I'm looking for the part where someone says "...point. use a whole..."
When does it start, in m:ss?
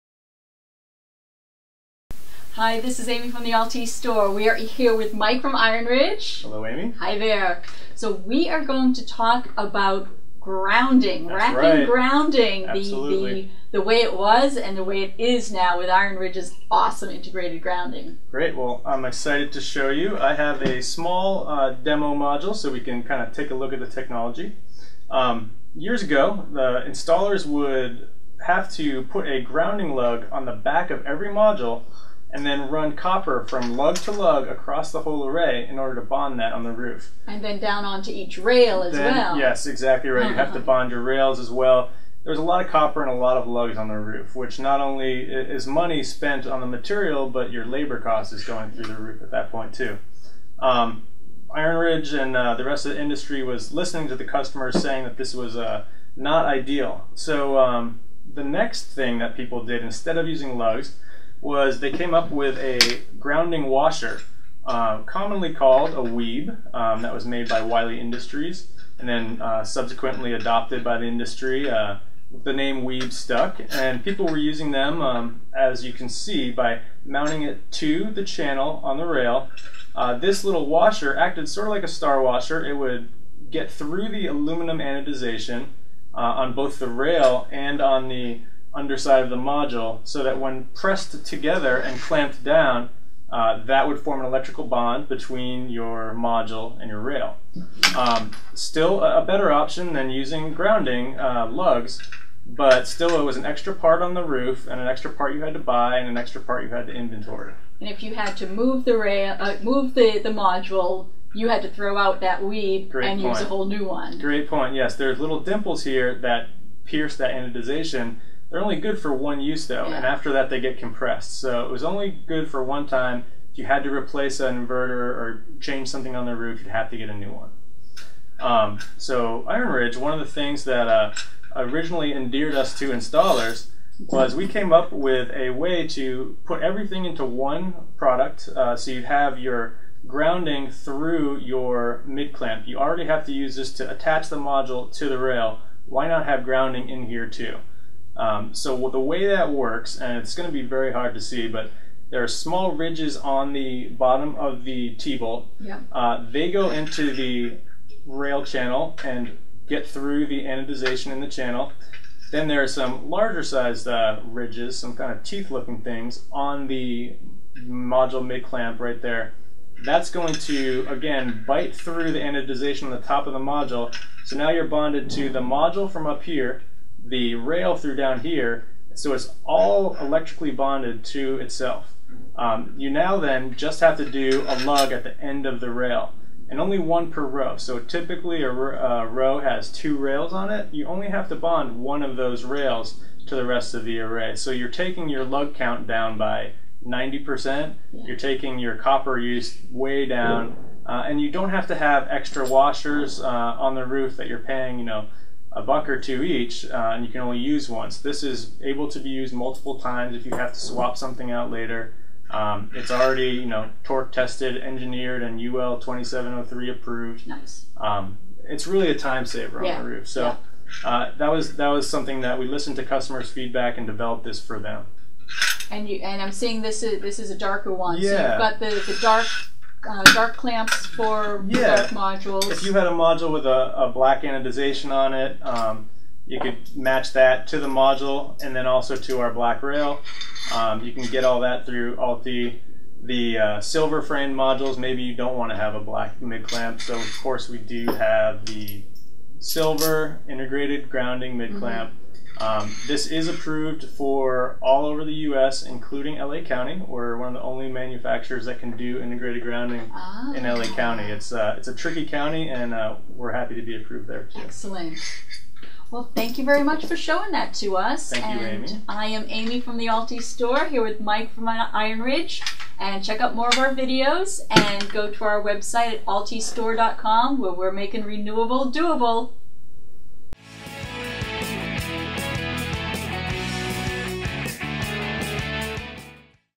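1:53.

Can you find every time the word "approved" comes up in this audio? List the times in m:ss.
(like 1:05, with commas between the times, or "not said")
3:36, 4:13, 4:23.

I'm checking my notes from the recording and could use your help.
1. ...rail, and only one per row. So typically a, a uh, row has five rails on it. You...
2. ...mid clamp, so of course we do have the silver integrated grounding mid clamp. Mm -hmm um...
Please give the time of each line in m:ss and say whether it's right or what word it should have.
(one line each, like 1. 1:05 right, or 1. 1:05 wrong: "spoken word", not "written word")
1. 3:05 wrong: "two", not "five"
2. 4:06 right.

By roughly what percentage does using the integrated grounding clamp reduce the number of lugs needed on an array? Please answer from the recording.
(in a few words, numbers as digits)
90%.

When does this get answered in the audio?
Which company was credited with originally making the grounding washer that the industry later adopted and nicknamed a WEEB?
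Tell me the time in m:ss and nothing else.
1:07.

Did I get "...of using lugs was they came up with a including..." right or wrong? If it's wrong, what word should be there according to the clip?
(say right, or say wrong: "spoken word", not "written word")
wrong: "grounding", not "including".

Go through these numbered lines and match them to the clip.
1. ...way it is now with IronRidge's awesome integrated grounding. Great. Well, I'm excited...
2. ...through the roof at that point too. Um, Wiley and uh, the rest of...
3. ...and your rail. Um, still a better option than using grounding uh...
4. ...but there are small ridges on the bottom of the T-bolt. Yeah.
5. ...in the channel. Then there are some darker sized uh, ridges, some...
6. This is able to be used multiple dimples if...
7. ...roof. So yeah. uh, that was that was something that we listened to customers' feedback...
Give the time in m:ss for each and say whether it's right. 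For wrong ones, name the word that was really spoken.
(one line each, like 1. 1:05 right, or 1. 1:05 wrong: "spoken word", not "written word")
1. 0:14 right
2. 0:48 wrong: "IronRidge", not "Wiley"
3. 1:36 right
4. 2:31 right
5. 2:41 wrong: "larger", not "darker"
6. 3:27 wrong: "times", not "dimples"
7. 3:39 right.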